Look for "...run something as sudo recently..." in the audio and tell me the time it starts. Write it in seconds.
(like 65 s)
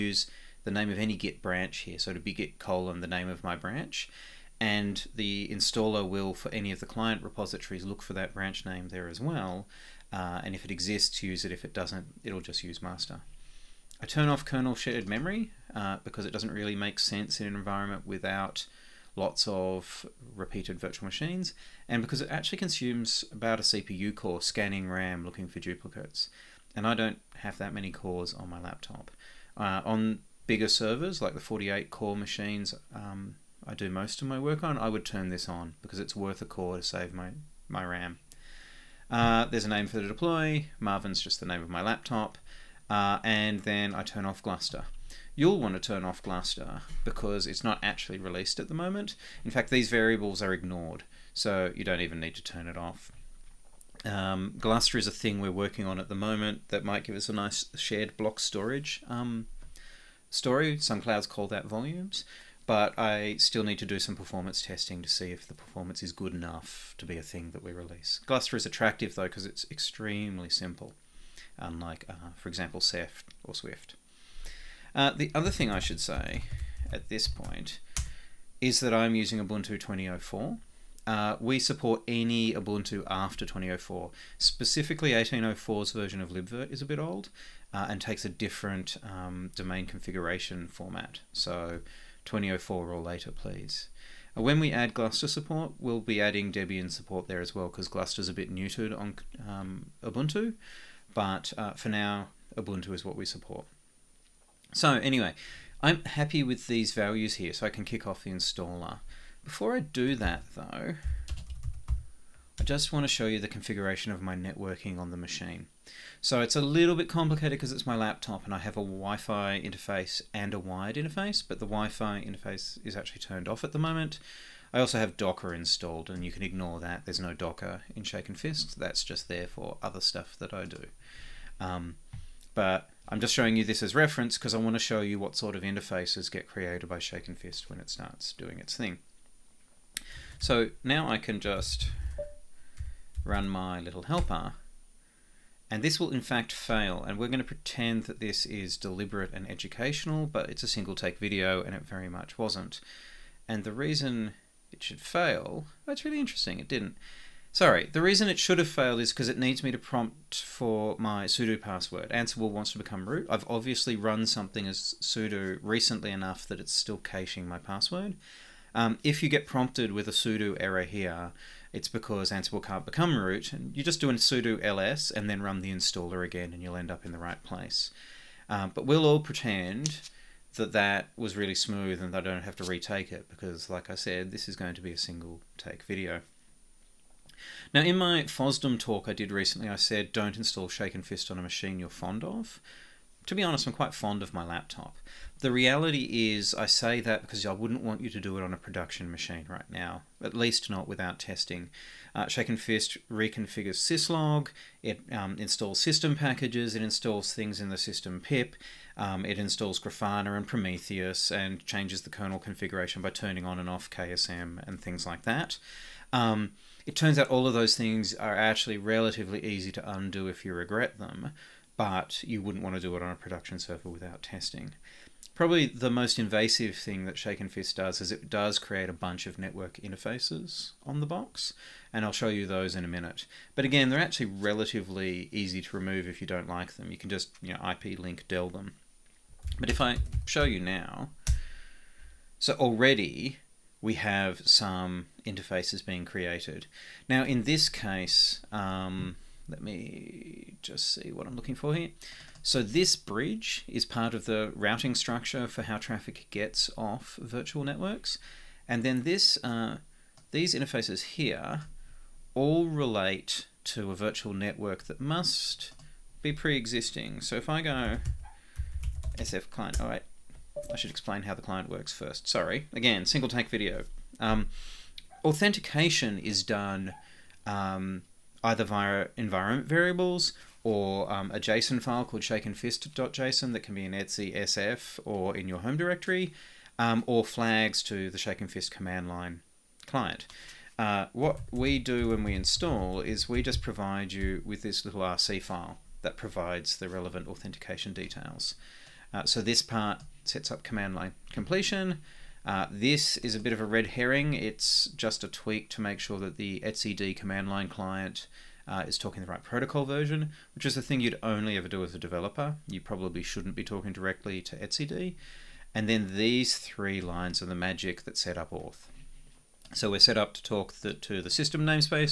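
163 s.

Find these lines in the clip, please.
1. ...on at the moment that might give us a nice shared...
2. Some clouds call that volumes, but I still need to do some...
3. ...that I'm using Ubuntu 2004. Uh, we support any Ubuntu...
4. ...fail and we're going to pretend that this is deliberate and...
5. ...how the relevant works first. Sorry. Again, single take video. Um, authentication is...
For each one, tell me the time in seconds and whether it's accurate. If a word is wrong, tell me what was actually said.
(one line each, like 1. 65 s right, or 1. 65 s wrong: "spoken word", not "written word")
1. 55 s right
2. 60 s right
3. 78 s right
4. 146 s right
5. 271 s wrong: "client", not "relevant".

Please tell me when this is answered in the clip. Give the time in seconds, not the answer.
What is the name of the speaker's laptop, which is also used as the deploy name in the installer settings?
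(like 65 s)
40 s.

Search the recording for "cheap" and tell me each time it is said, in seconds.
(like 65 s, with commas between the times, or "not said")
not said.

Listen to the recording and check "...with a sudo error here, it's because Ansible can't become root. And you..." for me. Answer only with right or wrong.
right.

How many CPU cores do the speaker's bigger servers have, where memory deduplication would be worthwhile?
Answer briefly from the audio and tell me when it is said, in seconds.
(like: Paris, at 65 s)
48, at 31 s.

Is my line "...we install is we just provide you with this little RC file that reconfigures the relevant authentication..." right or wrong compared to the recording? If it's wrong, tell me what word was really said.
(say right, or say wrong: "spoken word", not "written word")
wrong: "provides", not "reconfigures".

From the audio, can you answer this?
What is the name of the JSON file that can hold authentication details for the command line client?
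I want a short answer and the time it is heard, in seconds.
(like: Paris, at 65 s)
shakenfist.json, at 282 s.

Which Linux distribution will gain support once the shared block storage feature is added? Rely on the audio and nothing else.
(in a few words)
Debian.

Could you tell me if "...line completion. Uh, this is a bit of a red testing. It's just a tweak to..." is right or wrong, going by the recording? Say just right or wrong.
wrong.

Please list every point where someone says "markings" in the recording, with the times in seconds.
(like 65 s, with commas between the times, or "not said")
not said.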